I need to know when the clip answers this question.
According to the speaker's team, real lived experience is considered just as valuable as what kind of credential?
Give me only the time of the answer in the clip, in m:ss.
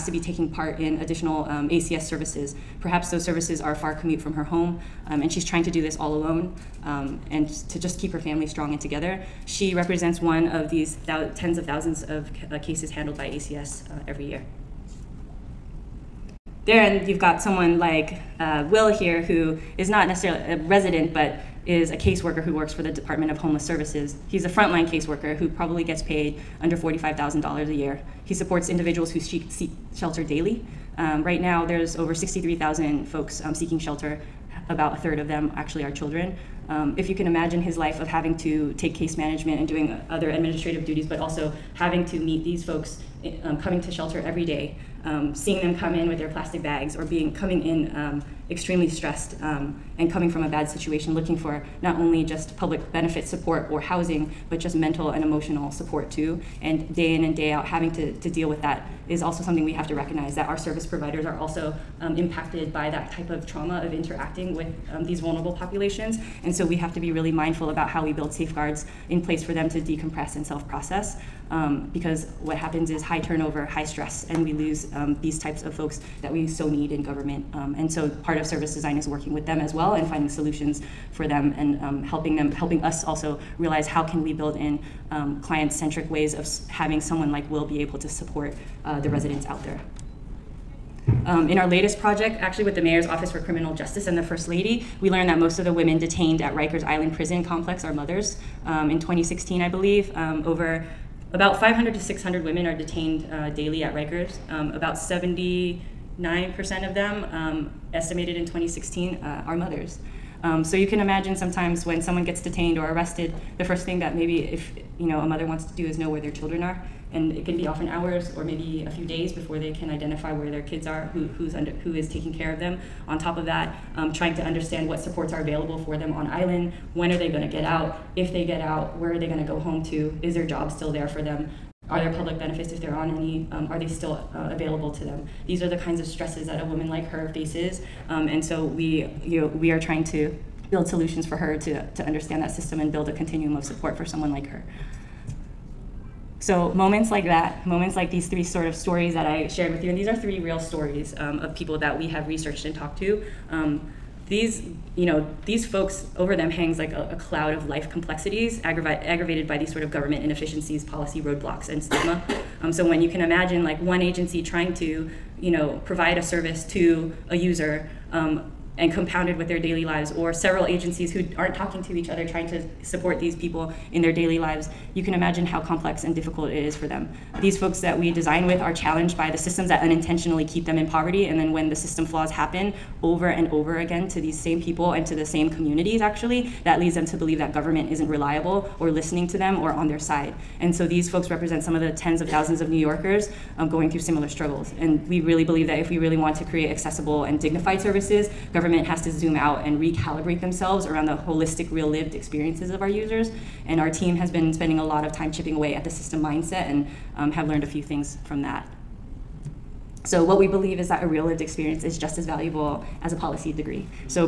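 3:33.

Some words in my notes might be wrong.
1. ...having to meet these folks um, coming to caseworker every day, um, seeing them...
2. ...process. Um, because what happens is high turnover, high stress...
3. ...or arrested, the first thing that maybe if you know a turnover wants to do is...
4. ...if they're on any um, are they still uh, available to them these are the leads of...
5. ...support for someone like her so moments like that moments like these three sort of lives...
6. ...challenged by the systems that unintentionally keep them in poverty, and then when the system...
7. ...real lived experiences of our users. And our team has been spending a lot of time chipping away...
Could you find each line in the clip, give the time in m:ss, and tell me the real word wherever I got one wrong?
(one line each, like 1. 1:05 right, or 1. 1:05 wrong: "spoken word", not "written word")
1. 0:41 wrong: "shelter", not "caseworker"
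2. 1:10 right
3. 1:52 wrong: "mother", not "turnover"
4. 2:12 wrong: "kinds", not "leads"
5. 2:23 wrong: "stories", not "lives"
6. 2:58 right
7. 3:21 right.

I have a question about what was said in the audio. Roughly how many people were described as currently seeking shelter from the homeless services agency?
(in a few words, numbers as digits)
63,000.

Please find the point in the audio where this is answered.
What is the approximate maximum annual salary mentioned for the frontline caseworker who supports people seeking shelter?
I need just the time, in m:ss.
0:26.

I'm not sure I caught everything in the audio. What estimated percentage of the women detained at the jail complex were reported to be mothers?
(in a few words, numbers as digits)
79%.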